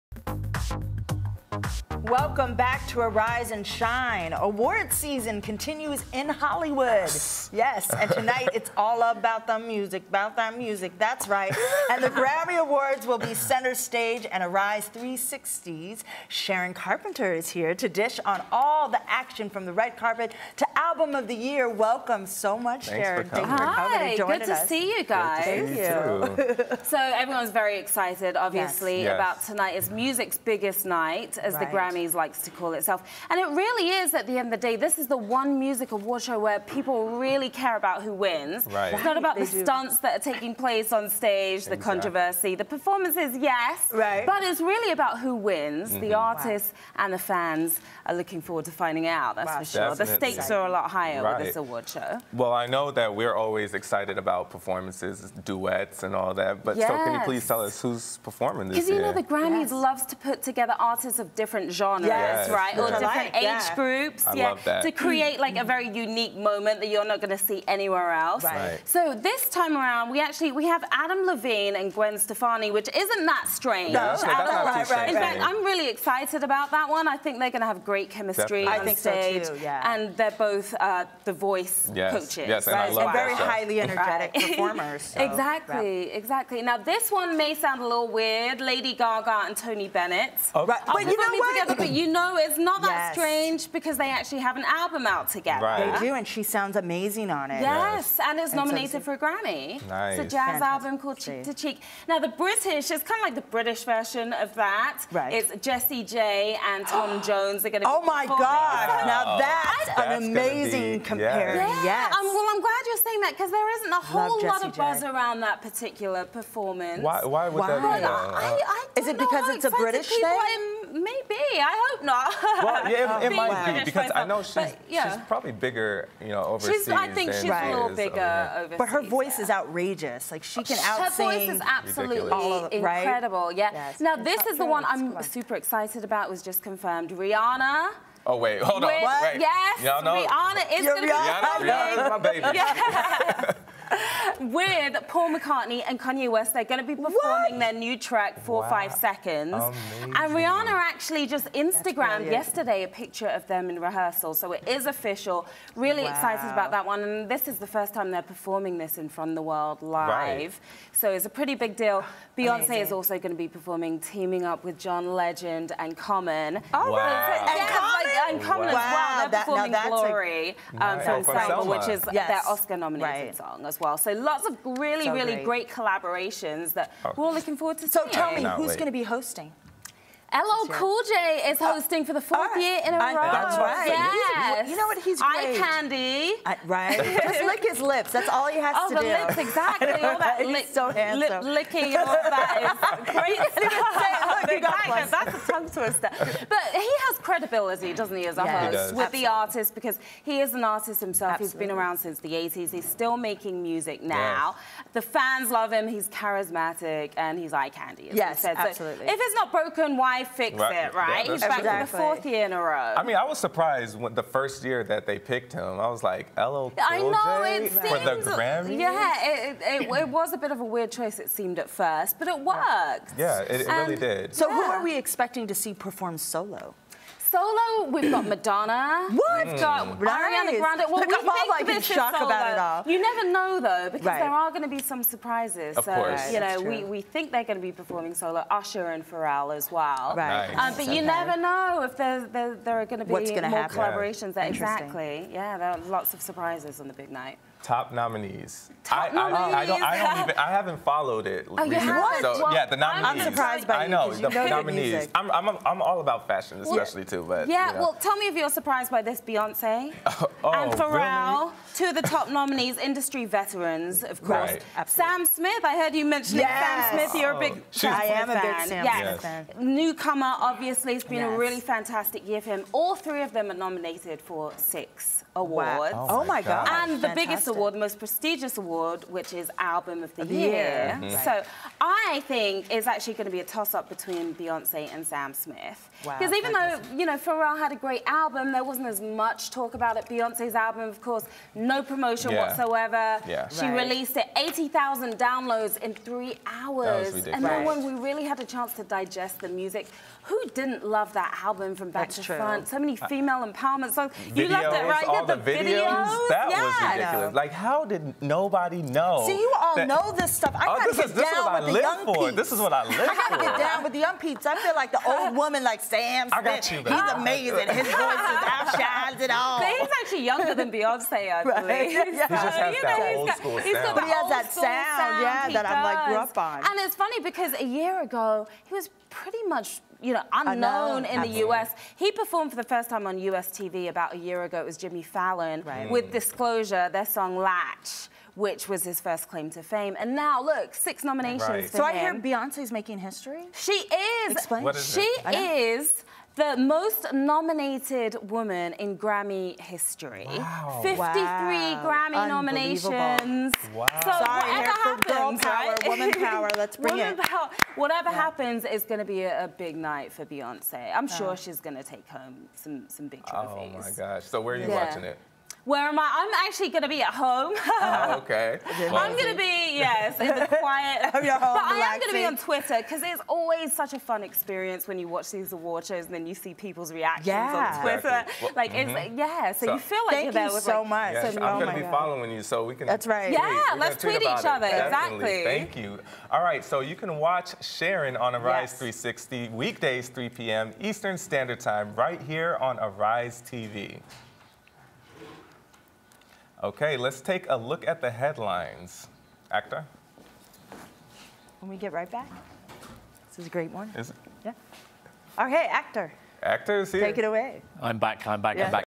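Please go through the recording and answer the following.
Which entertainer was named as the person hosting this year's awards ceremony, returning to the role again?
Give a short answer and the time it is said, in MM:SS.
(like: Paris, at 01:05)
LL Cool J, at 03:00.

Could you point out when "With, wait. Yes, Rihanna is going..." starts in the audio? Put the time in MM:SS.
02:18.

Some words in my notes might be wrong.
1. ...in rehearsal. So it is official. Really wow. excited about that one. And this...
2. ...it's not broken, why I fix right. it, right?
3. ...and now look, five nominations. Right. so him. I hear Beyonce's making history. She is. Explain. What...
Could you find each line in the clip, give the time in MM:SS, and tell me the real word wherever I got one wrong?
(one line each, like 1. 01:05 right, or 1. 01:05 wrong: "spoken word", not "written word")
1. 02:33 right
2. 03:29 right
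3. 05:39 wrong: "six", not "five".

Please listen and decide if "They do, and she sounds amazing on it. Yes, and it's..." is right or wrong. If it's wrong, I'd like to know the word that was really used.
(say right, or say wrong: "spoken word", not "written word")
right.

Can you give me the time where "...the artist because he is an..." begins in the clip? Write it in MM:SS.
03:19.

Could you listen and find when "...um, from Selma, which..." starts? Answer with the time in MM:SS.
02:50.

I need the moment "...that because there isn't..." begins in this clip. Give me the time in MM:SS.
01:53.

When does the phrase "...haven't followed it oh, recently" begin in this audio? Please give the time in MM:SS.
04:10.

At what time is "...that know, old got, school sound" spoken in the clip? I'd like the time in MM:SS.
05:22.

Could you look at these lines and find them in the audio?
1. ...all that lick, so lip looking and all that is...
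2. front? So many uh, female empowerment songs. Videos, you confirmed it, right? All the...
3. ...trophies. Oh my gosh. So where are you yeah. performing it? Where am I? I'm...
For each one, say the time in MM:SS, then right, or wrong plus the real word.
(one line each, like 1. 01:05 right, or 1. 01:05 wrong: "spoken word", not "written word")
1. 03:09 wrong: "licking", not "looking"
2. 05:02 wrong: "loved", not "confirmed"
3. 06:03 wrong: "watching", not "performing".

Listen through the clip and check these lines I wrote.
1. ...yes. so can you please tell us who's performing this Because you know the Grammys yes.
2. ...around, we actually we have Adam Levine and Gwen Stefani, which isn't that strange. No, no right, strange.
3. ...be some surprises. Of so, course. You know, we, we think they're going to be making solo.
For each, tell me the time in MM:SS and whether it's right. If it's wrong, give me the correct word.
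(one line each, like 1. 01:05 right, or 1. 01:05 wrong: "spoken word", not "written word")
1. 00:56 right
2. 01:09 right
3. 03:54 wrong: "performing", not "making".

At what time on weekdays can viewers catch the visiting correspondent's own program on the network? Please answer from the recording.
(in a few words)
3 p.m. Eastern.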